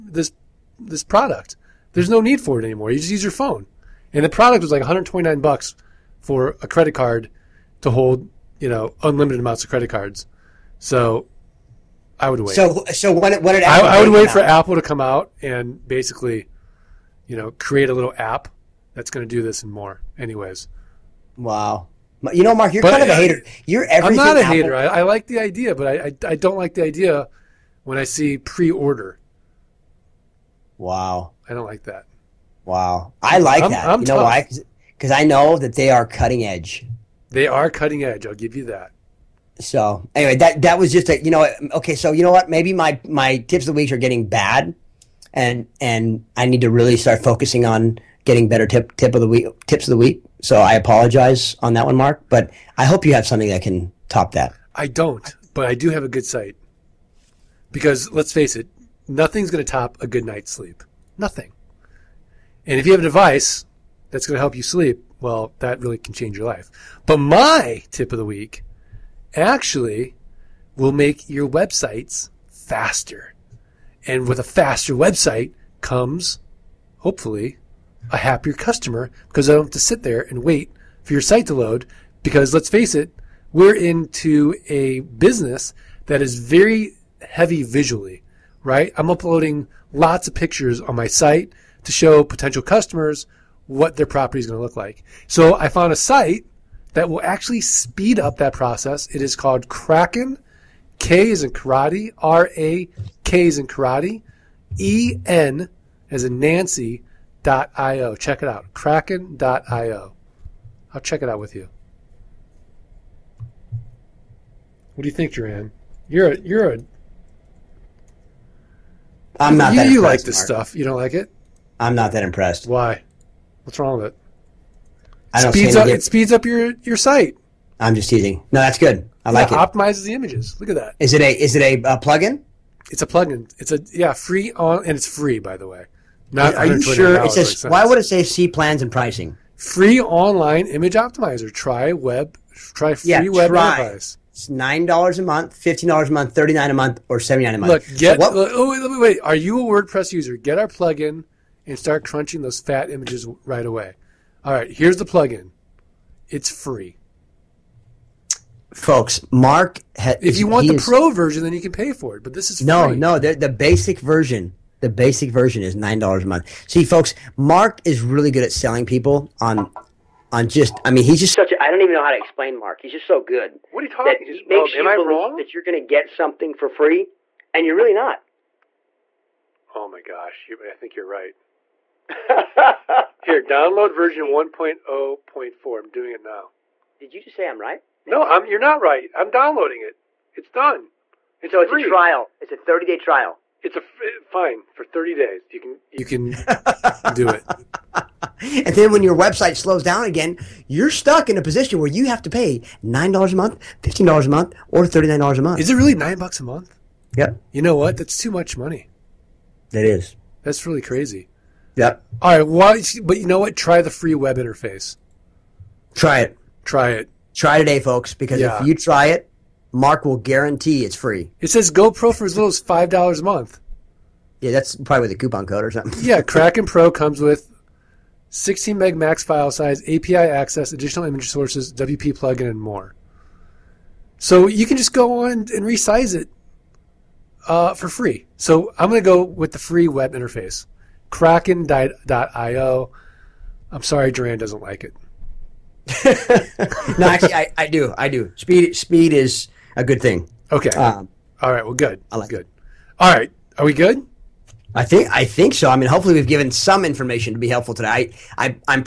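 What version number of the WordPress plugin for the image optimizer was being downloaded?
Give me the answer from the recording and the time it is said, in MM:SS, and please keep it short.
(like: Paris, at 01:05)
1.0.4, at 03:04.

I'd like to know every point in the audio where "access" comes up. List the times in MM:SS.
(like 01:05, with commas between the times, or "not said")
03:50.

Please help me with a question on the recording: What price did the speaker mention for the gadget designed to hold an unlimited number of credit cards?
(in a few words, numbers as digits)
$129.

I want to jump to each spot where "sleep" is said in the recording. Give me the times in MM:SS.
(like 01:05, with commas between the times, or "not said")
01:00, 01:04.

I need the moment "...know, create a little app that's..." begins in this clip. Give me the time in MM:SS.
00:17.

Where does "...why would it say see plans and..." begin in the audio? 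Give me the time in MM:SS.
02:17.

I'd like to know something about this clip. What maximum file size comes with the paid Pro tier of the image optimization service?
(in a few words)
16 MB.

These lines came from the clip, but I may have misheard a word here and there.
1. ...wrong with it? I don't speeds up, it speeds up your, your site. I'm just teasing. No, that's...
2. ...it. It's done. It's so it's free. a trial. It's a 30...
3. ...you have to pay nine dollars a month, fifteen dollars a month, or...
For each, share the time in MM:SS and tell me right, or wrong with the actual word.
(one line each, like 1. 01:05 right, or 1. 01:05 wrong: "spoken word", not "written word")
1. 02:03 right
2. 03:09 right
3. 03:21 right.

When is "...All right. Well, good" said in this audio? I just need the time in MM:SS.
04:11.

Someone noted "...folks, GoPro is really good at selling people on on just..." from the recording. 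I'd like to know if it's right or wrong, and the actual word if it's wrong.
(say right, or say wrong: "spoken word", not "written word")
wrong: "Mark", not "GoPro".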